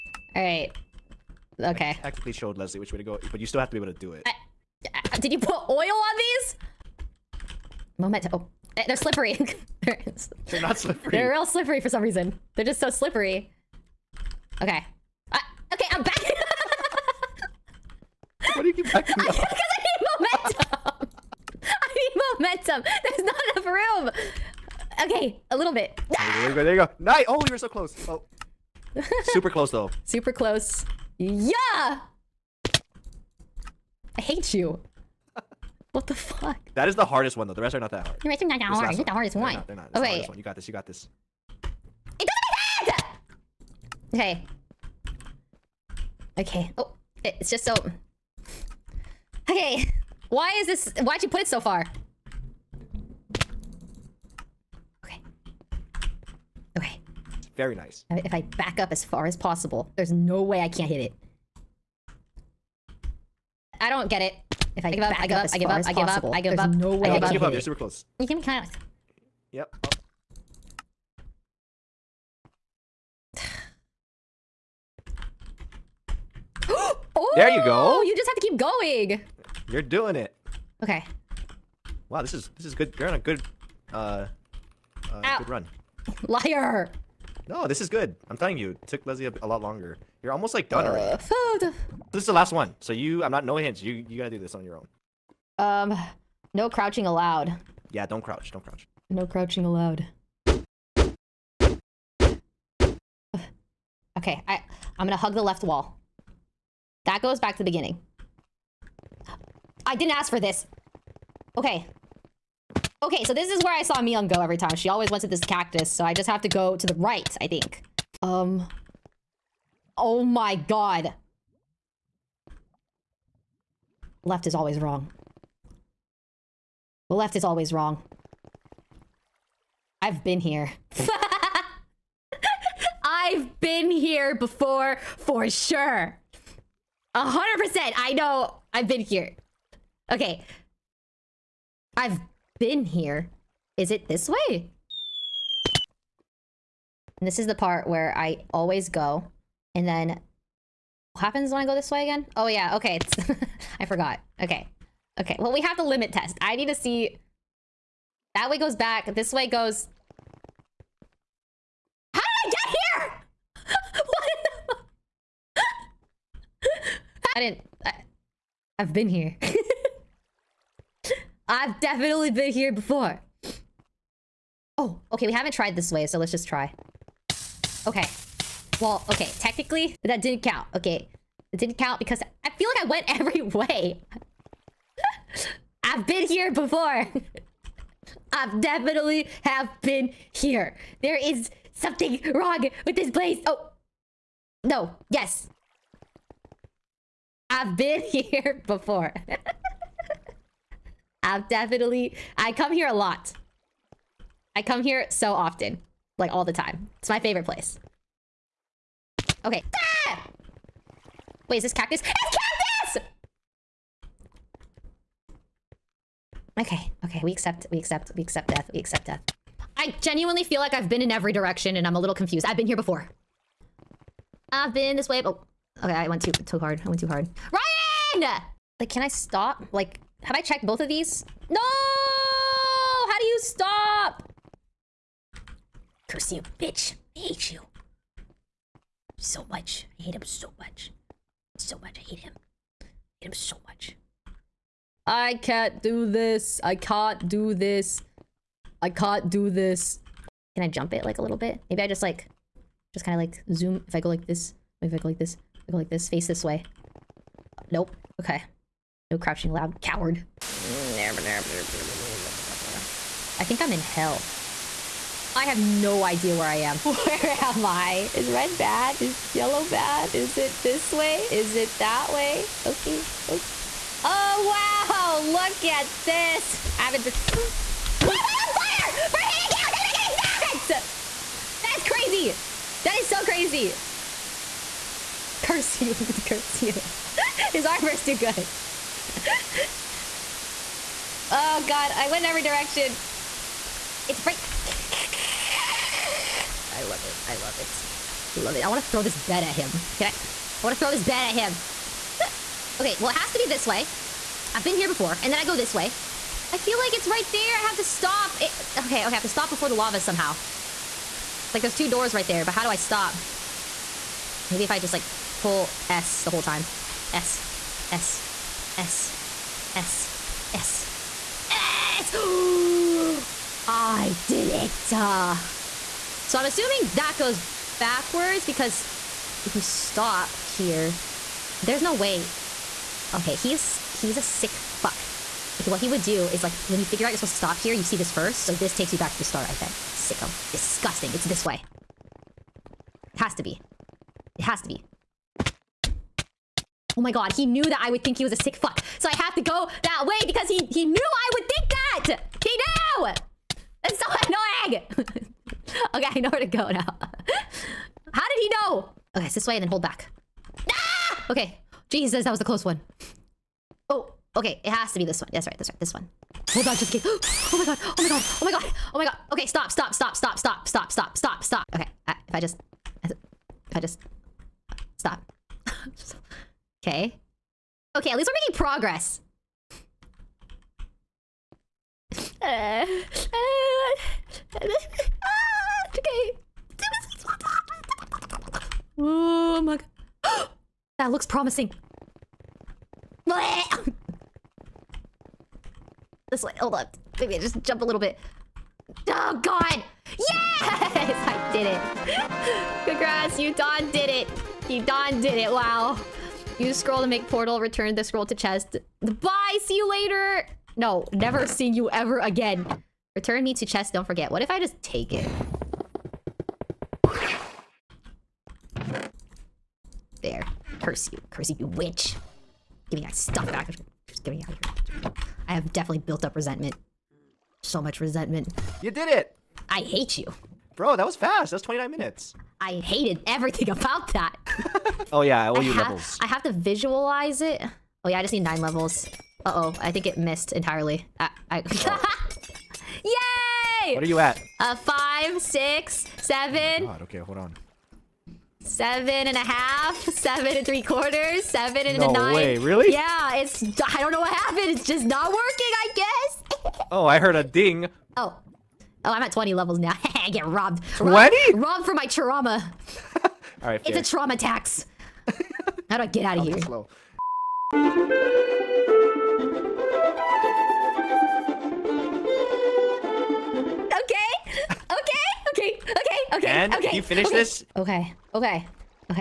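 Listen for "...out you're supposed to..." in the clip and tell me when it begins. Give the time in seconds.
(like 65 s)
337 s.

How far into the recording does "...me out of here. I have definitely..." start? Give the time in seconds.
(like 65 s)
424 s.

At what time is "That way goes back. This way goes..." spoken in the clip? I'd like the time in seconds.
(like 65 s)
158 s.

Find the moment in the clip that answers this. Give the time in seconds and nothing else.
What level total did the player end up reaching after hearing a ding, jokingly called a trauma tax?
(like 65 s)
459 s.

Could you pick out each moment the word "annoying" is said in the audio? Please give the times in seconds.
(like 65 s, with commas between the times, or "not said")
354 s.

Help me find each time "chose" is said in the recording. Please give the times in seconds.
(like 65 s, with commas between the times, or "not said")
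not said.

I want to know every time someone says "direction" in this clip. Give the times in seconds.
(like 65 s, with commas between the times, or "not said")
221 s, 292 s.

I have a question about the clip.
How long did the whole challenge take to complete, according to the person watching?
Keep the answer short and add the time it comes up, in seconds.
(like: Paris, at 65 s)
29 minutes, at 431 s.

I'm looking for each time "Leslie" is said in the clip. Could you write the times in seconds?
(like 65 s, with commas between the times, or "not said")
2 s, 89 s.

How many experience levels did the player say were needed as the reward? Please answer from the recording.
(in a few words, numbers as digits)
9.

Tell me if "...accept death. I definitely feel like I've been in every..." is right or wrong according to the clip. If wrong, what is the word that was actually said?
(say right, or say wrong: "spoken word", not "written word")
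wrong: "genuinely", not "definitely".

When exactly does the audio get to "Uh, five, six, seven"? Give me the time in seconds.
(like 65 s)
444 s.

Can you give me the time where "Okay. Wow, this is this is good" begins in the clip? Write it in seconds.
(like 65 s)
80 s.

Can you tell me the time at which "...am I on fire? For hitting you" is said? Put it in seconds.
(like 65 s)
278 s.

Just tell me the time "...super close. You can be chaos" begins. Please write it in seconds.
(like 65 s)
67 s.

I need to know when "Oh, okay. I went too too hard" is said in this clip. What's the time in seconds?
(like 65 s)
225 s.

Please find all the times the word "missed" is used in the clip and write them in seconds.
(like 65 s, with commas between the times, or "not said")
440 s.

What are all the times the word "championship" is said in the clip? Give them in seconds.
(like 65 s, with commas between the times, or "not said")
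not said.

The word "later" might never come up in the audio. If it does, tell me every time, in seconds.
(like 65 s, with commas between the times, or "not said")
409 s.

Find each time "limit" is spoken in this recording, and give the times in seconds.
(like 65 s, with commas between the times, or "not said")
155 s.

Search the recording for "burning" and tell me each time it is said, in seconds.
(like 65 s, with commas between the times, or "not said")
not said.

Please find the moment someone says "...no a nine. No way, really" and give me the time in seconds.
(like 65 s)
451 s.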